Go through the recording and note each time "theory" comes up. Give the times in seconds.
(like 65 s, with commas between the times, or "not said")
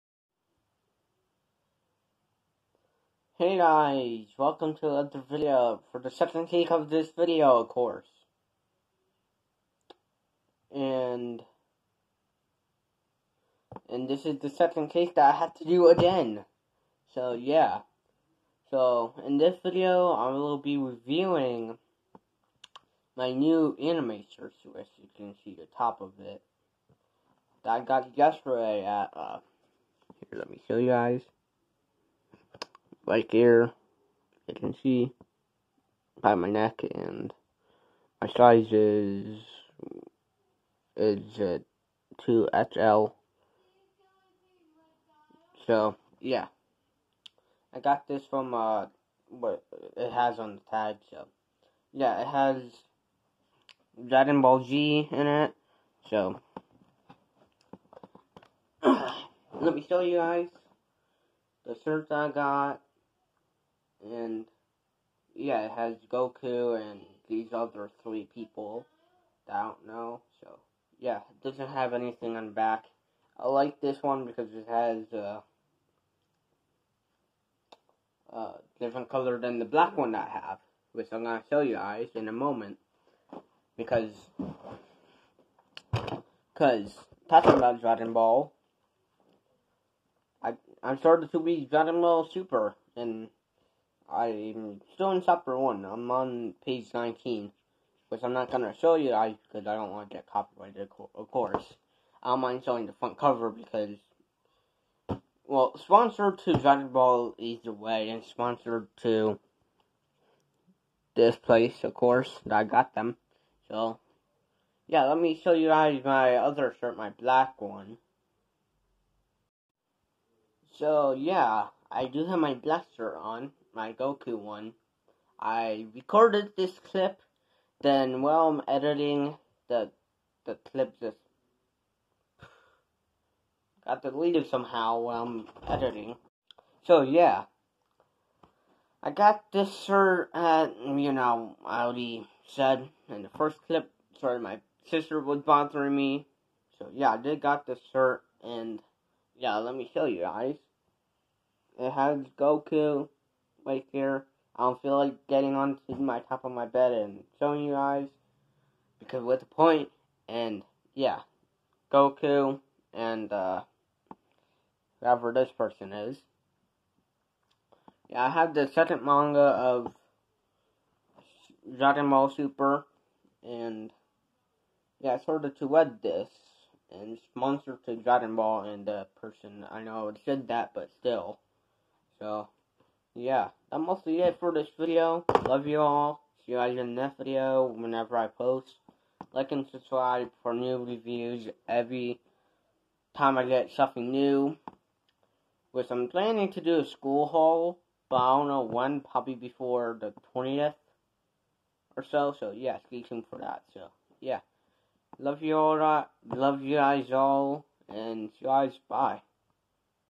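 not said.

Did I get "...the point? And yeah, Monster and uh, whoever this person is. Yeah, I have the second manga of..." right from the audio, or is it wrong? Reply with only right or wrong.
wrong.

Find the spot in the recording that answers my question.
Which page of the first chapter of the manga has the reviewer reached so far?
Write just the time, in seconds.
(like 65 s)
96 s.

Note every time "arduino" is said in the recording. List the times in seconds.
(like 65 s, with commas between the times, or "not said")
not said.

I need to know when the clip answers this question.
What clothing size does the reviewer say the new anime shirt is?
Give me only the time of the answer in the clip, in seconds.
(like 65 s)
42 s.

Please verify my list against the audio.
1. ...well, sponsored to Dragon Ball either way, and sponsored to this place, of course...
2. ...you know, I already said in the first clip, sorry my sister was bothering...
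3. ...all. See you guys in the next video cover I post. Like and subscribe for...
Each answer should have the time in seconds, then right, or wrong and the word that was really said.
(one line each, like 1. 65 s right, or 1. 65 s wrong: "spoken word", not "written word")
1. 105 s right
2. 140 s right
3. 185 s wrong: "whenever", not "cover".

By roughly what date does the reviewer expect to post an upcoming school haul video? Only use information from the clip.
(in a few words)
the 20th.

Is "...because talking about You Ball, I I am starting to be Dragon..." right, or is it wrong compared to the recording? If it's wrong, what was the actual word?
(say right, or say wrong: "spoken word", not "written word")
wrong: "Dragon", not "You".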